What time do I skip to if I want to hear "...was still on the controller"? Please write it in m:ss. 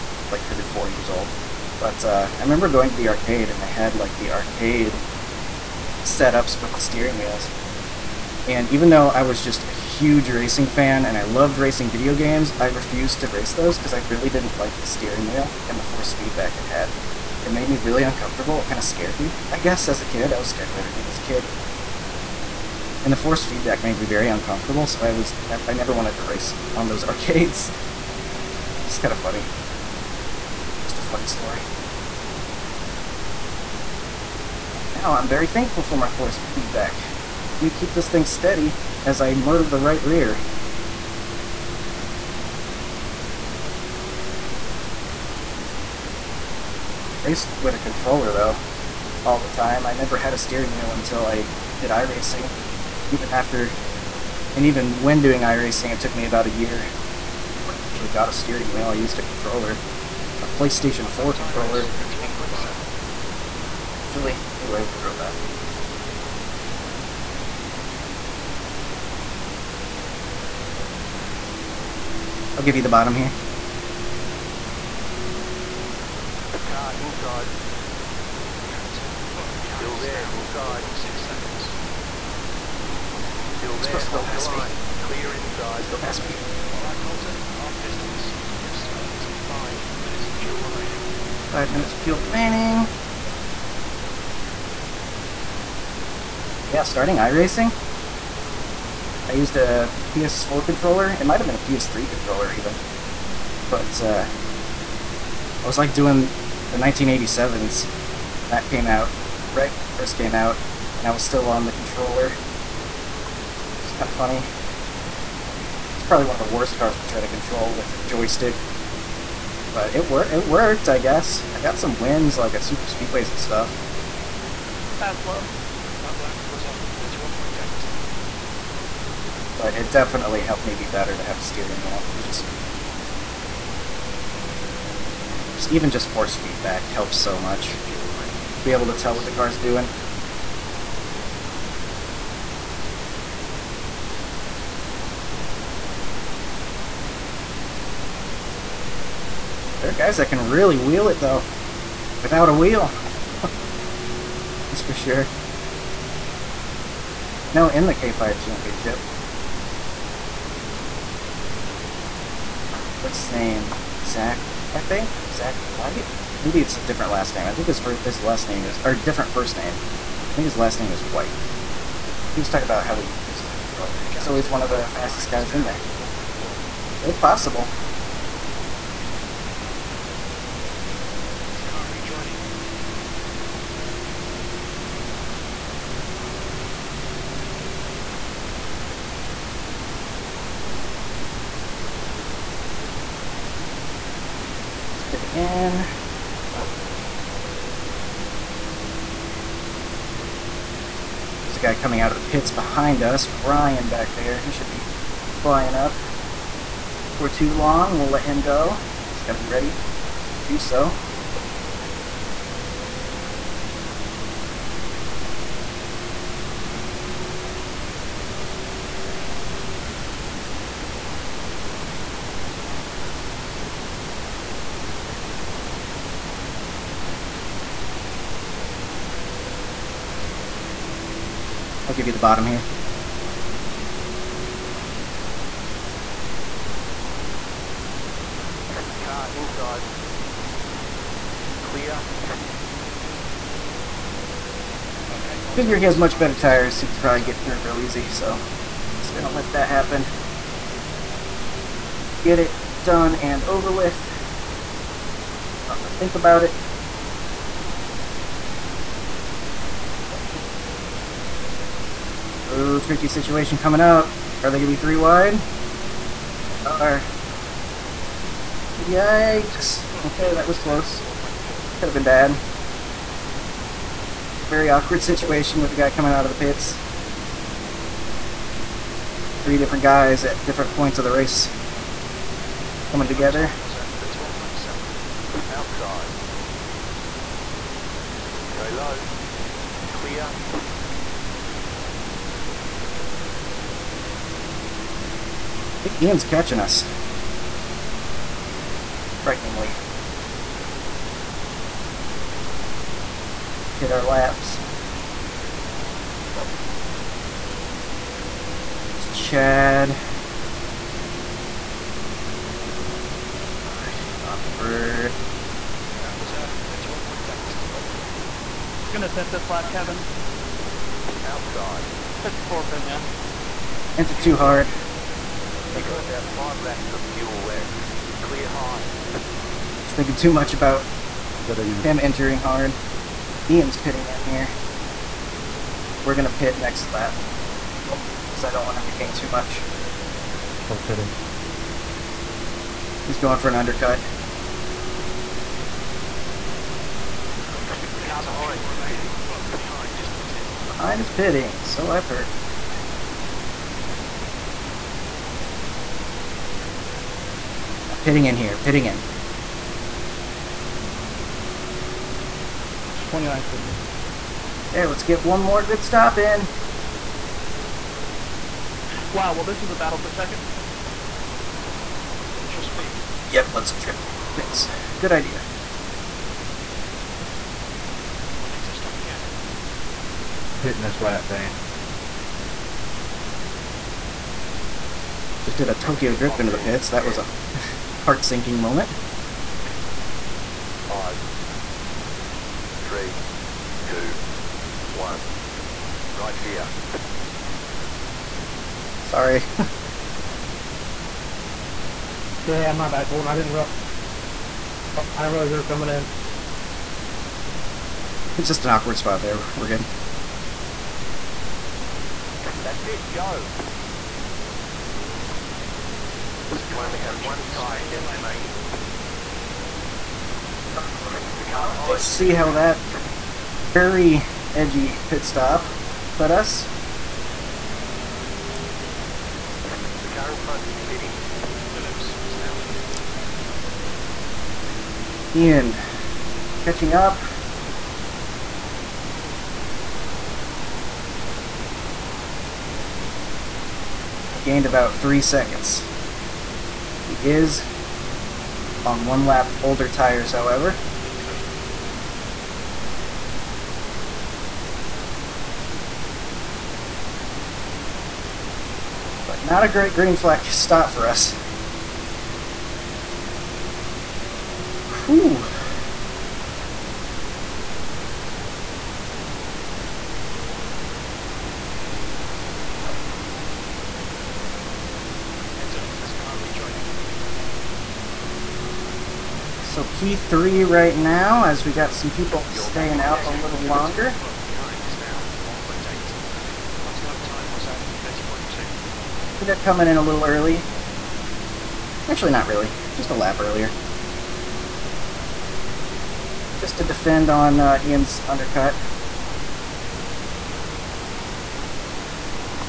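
1:51.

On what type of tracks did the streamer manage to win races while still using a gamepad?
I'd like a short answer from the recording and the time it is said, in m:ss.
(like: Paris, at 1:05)
Super Speedways, at 2:02.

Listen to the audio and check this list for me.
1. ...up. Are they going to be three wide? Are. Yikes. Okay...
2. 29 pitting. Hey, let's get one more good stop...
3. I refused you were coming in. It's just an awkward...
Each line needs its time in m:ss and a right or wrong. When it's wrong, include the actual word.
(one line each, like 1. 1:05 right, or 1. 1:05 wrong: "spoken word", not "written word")
1. 4:23 right
2. 6:03 right
3. 6:45 wrong: "realized", not "refused".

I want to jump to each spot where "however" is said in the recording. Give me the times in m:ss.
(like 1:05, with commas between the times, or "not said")
7:30.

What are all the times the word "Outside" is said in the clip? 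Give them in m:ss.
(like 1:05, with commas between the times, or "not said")
4:43, 5:21.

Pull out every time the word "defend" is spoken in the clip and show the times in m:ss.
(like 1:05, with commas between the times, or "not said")
8:16.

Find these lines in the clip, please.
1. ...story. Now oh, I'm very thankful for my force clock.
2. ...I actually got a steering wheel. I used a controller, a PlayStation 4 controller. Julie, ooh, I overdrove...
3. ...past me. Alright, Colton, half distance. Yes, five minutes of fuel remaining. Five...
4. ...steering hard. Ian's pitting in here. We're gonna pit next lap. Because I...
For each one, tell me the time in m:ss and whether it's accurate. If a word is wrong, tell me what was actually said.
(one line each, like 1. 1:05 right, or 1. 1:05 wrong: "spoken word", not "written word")
1. 0:31 wrong: "feedback", not "clock"
2. 0:57 right
3. 1:26 right
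4. 5:31 wrong: "entering", not "steering".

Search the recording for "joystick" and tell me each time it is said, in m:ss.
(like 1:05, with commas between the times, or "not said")
1:58.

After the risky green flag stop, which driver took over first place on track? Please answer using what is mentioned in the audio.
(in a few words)
Phillips.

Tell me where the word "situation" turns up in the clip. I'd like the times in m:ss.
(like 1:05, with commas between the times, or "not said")
4:23, 4:35.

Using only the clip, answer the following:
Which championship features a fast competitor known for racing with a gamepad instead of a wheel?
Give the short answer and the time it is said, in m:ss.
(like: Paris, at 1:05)
K5 Championship, at 2:37.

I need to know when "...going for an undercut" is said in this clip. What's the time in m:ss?
5:43.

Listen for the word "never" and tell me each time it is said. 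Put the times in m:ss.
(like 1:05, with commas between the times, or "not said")
0:25, 0:49.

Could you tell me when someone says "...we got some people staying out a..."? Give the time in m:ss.
8:01.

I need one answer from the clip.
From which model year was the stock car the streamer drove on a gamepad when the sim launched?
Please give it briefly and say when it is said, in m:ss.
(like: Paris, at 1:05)
1987, at 1:46.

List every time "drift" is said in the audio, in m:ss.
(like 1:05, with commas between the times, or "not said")
6:13, 6:26.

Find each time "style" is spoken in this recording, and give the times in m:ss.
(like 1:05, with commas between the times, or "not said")
not said.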